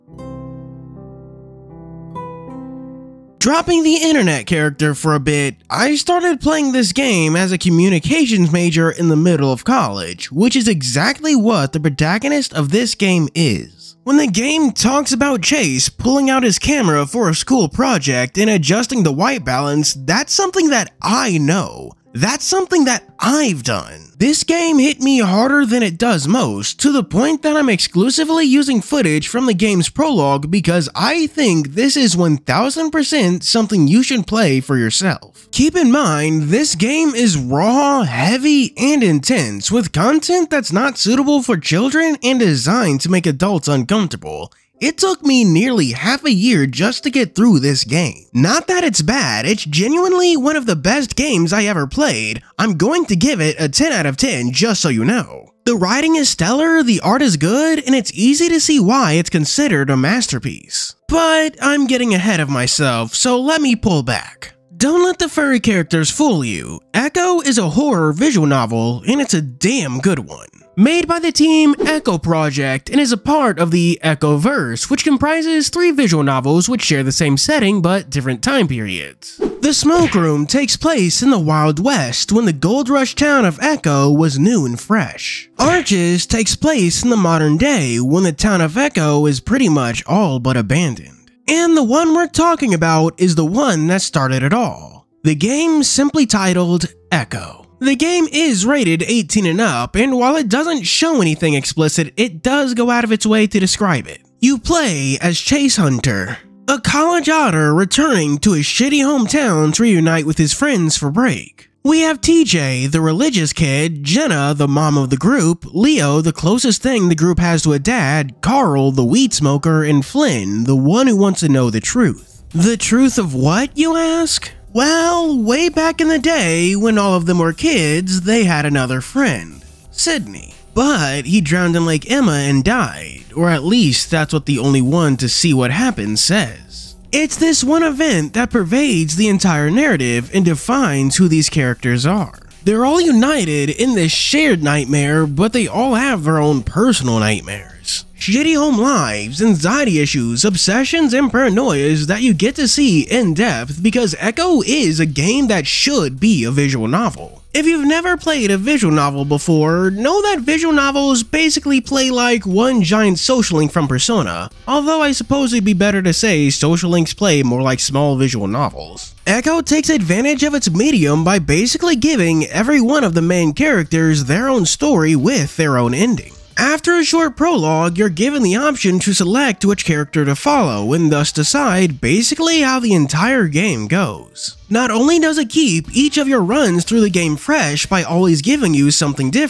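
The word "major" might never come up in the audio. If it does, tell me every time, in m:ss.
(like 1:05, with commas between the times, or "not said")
0:08.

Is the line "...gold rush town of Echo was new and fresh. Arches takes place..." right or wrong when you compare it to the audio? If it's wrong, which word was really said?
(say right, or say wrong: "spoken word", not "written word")
right.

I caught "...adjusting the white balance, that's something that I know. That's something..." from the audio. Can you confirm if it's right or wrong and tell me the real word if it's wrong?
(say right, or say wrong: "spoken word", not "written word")
right.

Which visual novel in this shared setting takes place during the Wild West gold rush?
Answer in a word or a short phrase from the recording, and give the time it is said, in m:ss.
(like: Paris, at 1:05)
The Smoke Room, at 1:19.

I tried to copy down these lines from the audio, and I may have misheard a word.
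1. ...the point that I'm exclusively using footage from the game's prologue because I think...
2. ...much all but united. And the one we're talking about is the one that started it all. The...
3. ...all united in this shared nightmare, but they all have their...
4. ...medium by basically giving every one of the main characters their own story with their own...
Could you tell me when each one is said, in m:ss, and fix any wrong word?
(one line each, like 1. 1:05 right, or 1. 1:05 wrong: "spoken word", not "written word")
1. 0:26 right
2. 1:29 wrong: "abandoned", not "united"
3. 2:22 right
4. 2:50 right.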